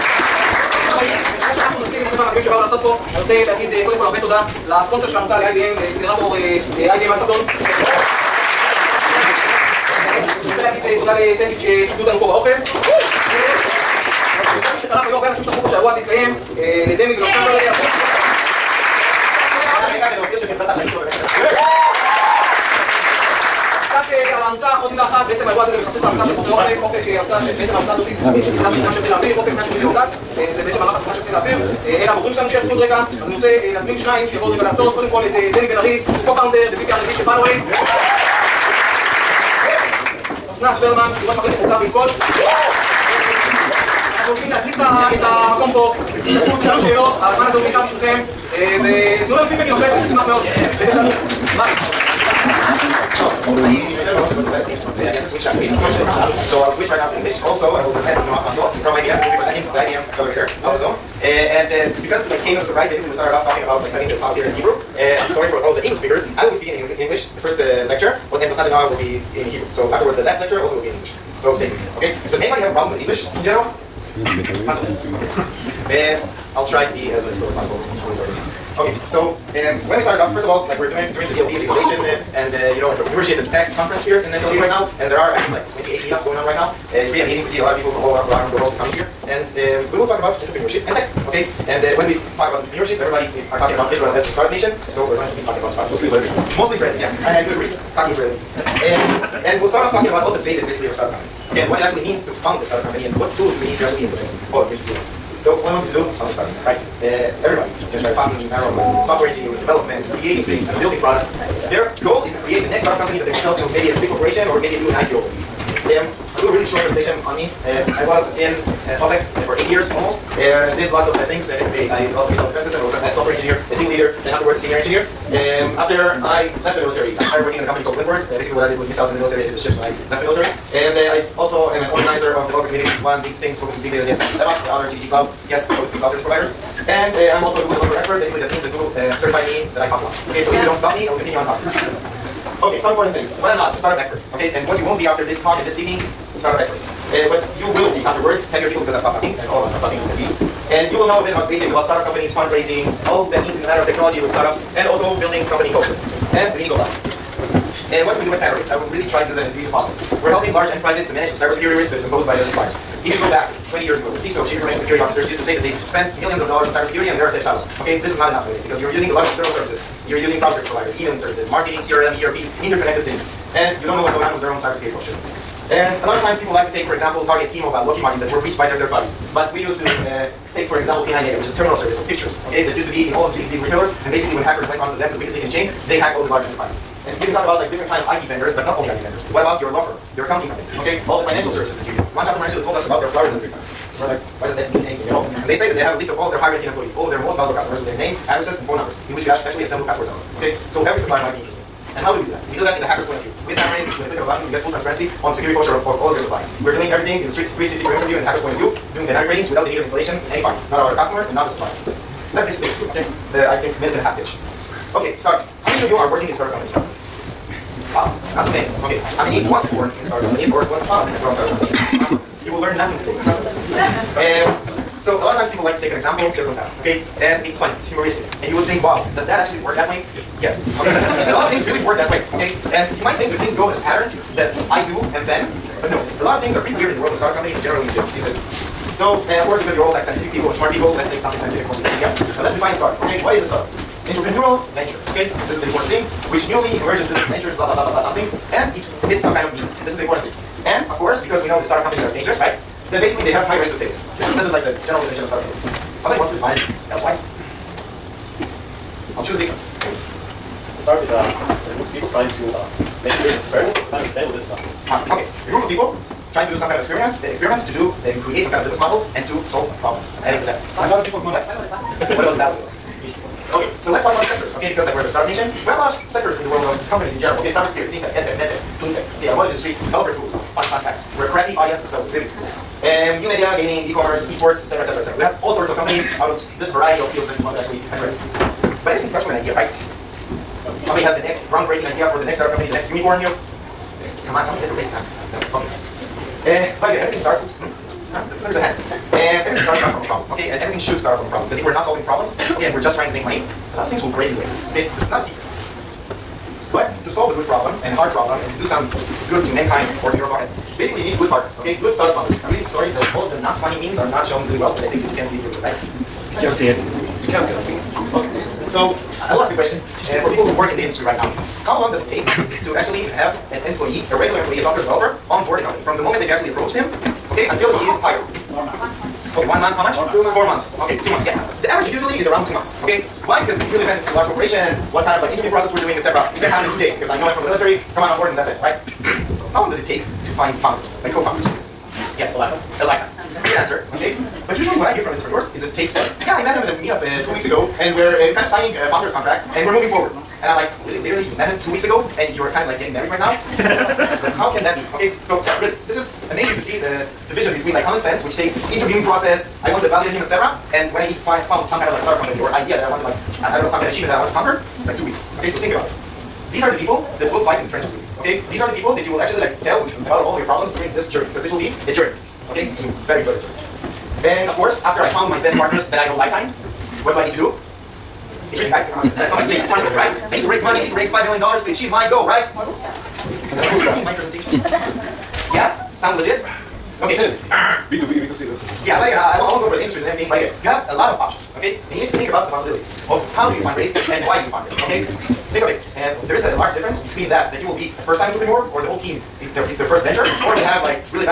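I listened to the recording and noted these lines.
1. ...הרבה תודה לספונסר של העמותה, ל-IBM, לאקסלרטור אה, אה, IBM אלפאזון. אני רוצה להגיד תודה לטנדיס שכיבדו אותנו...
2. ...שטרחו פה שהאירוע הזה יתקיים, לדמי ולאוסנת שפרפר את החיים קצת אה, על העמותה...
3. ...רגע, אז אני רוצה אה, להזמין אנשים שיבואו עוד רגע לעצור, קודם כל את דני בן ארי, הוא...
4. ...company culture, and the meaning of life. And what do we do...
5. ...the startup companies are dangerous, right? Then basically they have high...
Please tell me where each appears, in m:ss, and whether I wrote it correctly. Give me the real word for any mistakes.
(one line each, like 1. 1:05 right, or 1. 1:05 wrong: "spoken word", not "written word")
1. 0:04 right
2. 0:15 right
3. 0:32 wrong: "שניים", not "אנשים"
4. 2:35 right
5. 4:11 right.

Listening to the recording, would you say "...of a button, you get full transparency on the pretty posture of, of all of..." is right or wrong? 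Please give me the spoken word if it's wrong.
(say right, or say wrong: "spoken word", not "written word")
wrong: "security", not "pretty".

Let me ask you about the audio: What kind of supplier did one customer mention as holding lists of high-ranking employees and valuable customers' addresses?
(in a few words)
flower delivery company.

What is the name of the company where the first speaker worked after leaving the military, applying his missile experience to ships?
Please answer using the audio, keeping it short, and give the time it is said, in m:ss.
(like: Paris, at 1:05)
Windward, at 2:07.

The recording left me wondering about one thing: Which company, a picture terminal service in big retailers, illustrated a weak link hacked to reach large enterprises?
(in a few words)
P&I Media.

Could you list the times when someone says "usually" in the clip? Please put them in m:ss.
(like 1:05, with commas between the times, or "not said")
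5:31, 5:44.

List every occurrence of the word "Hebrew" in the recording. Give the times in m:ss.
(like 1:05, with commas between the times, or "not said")
1:04, 1:09.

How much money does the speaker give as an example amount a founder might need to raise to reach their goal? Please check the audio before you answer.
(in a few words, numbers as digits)
$5 million.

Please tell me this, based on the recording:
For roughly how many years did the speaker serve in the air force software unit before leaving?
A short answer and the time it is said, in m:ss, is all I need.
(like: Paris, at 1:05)
8, at 1:59.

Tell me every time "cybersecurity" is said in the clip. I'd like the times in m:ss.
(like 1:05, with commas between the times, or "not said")
2:41, 2:46, 2:54, 4:37.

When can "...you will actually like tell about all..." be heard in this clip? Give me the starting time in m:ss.
6:09.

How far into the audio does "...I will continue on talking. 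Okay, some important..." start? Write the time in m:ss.
2:21.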